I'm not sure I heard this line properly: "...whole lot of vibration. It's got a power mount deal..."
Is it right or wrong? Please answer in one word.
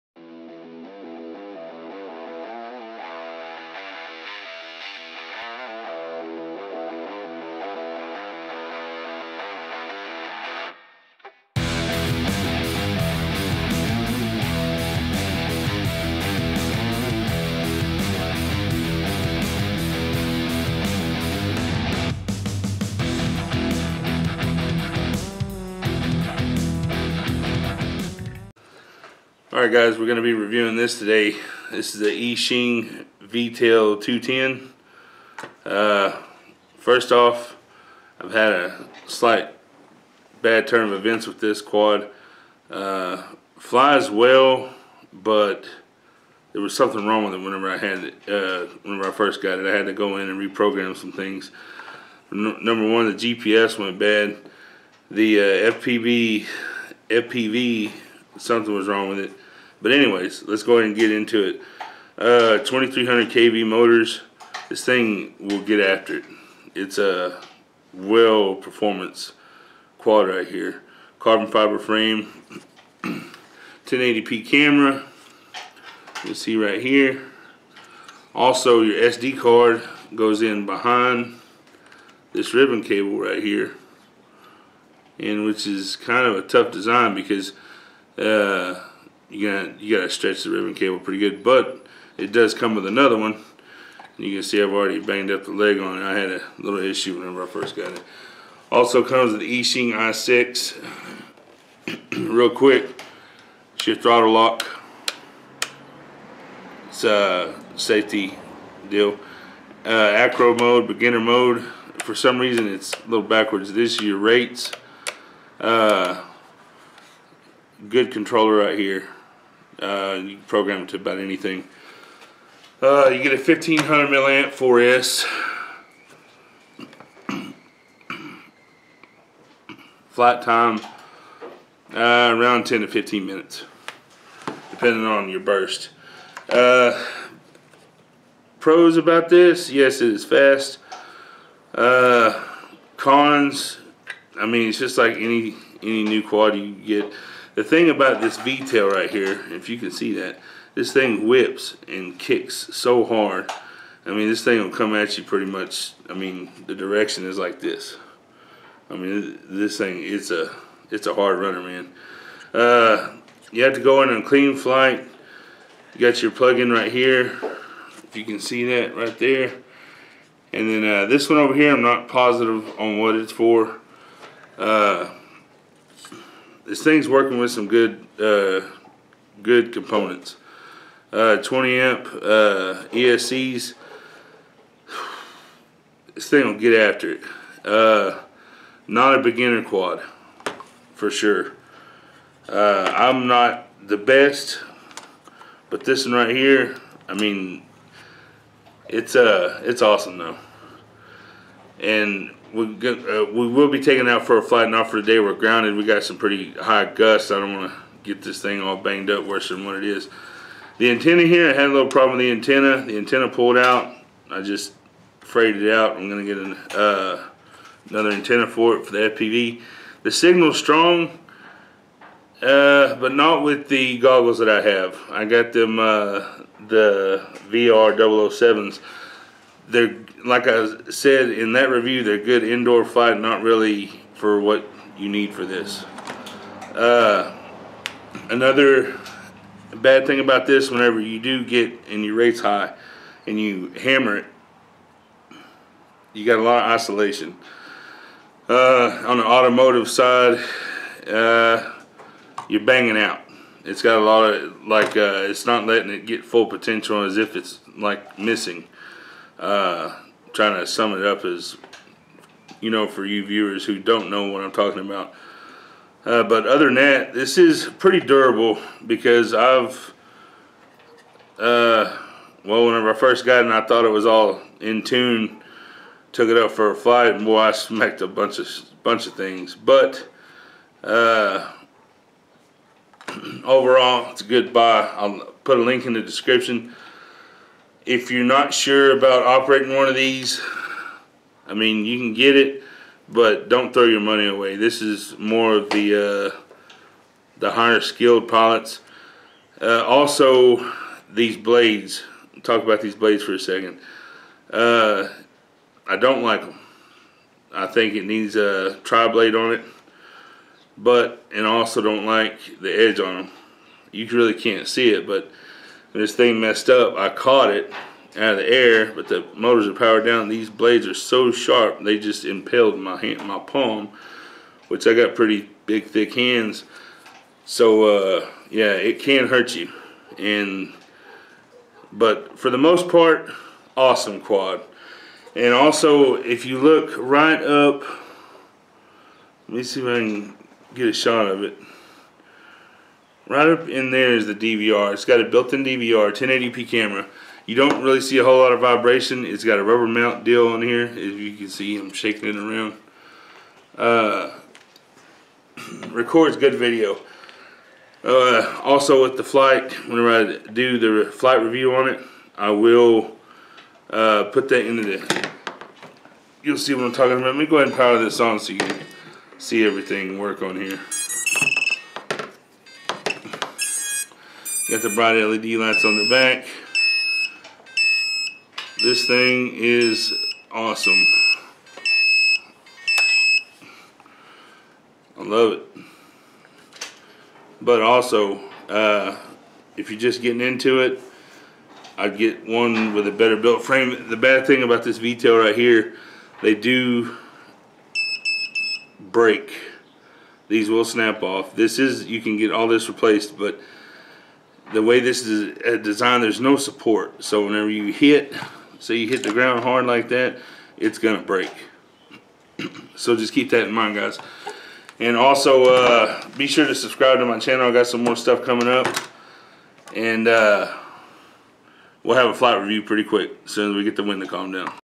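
wrong.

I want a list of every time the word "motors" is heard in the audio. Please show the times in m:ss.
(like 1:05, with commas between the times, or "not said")
1:03, 5:19.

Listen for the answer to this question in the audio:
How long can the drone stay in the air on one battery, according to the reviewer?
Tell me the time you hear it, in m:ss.
2:12.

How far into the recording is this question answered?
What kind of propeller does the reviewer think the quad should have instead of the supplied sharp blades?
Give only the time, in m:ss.
5:08.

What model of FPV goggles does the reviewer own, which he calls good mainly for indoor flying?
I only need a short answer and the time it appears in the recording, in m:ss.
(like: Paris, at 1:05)
VR 007, at 3:47.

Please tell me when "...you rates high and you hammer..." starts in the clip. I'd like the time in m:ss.
4:02.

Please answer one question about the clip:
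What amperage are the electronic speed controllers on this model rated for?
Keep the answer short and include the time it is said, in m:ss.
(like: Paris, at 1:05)
20 amp, at 3:01.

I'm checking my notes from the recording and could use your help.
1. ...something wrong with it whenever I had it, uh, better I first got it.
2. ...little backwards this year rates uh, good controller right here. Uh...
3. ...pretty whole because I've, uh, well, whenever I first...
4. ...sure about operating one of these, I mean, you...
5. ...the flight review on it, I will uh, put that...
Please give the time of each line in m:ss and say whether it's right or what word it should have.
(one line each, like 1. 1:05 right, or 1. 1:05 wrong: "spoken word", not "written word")
1. 0:46 wrong: "whenever", not "better"
2. 1:53 right
3. 4:27 wrong: "durable", not "whole"
4. 4:48 right
5. 6:01 right.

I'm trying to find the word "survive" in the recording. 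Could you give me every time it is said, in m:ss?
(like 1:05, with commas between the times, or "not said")
not said.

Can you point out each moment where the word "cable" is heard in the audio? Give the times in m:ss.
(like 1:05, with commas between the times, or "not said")
1:22, 1:30.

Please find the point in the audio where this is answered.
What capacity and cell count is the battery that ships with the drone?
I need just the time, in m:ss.
2:03.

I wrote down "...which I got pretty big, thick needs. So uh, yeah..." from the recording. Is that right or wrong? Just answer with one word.
wrong.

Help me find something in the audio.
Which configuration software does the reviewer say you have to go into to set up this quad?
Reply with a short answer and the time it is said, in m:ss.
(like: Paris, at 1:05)
Cleanflight, at 2:44.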